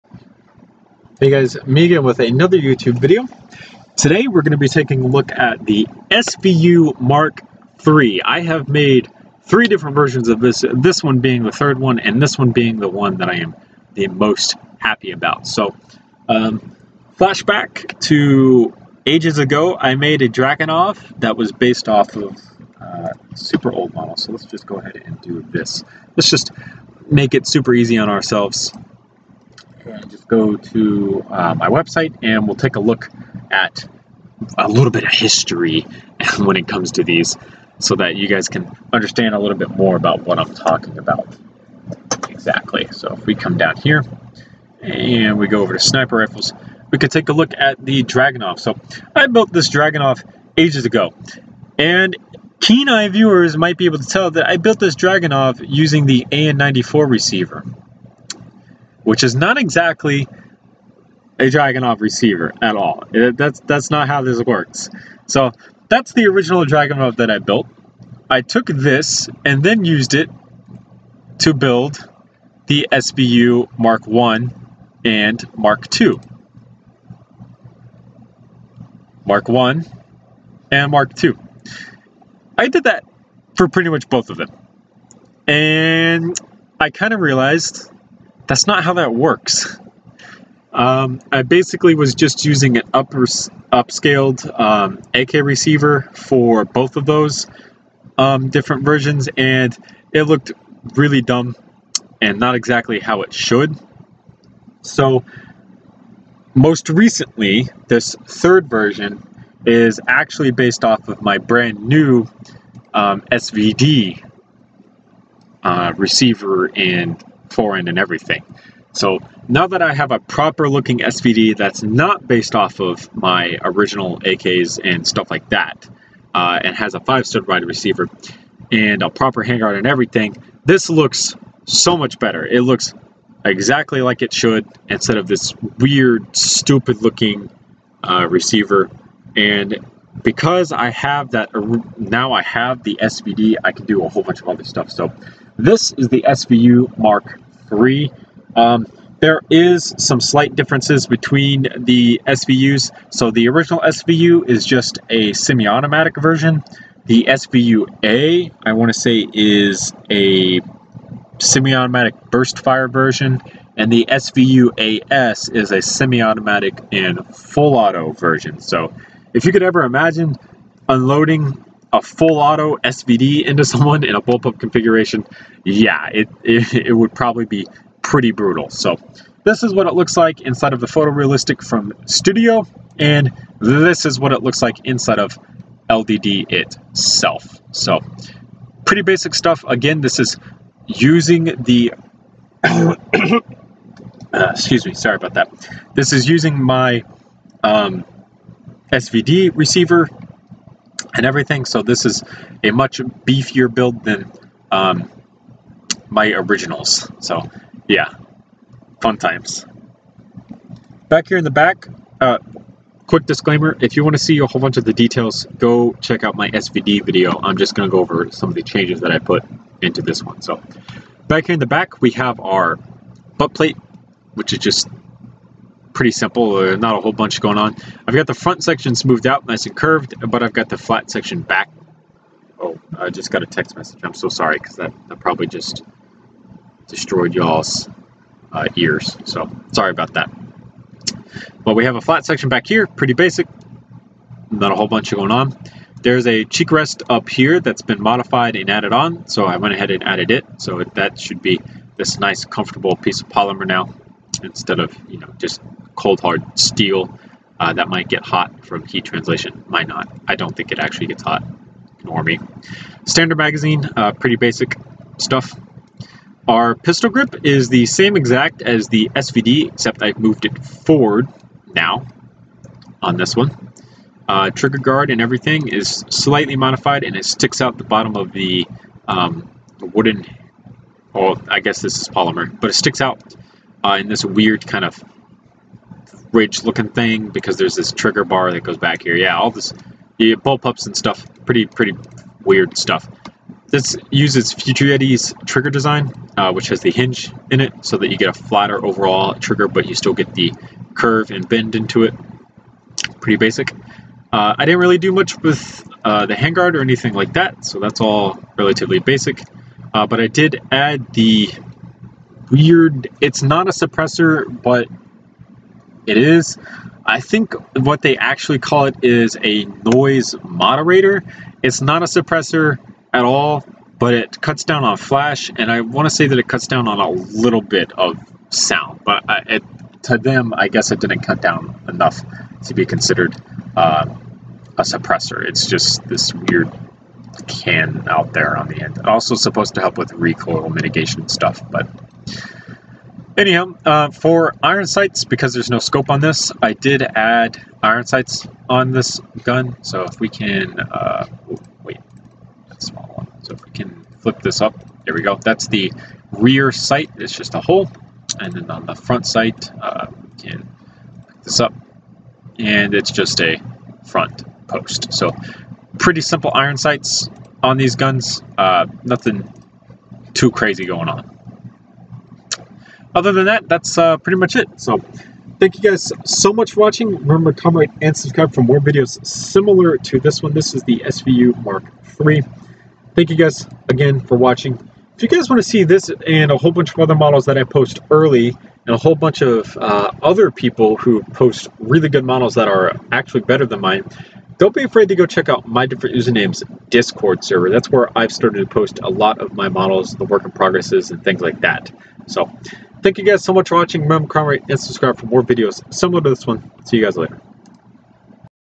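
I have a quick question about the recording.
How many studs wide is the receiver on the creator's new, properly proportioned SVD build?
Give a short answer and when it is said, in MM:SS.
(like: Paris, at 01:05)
5, at 02:06.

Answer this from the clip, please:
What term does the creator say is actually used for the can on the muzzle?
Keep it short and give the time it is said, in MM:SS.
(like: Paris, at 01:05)
noise moderator, at 05:19.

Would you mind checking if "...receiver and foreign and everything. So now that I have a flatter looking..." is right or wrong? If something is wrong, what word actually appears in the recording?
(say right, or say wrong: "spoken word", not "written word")
wrong: "proper", not "flatter".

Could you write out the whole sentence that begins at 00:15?
So, um, flashback to ages ago, I made a Dragunov that was based off of uh, super old model.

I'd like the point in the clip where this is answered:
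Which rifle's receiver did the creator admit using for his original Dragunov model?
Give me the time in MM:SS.
00:56.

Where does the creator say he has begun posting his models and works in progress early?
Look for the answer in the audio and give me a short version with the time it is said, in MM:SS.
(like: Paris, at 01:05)
Discord server, at 06:36.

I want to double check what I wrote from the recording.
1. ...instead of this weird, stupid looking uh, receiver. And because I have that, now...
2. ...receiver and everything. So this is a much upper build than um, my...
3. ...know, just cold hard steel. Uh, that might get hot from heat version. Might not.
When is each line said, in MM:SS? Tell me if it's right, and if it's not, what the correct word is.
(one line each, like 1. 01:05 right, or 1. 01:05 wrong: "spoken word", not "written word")
1. 02:14 right
2. 03:19 wrong: "beefier", not "upper"
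3. 04:15 wrong: "translation", not "version".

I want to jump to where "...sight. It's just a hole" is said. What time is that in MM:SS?
05:56.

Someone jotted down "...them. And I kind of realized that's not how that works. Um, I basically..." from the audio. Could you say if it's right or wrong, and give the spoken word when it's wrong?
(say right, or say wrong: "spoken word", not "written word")
right.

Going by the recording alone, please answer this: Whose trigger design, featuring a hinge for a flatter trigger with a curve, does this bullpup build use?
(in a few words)
Future Yeti.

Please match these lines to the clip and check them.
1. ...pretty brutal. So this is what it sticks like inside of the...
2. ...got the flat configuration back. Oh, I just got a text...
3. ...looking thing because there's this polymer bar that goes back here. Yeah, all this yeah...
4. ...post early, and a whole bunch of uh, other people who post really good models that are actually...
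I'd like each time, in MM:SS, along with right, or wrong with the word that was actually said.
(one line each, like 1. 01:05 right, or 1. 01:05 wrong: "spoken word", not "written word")
1. 02:58 wrong: "looks", not "sticks"
2. 03:50 wrong: "section", not "configuration"
3. 04:46 wrong: "trigger", not "polymer"
4. 06:27 right.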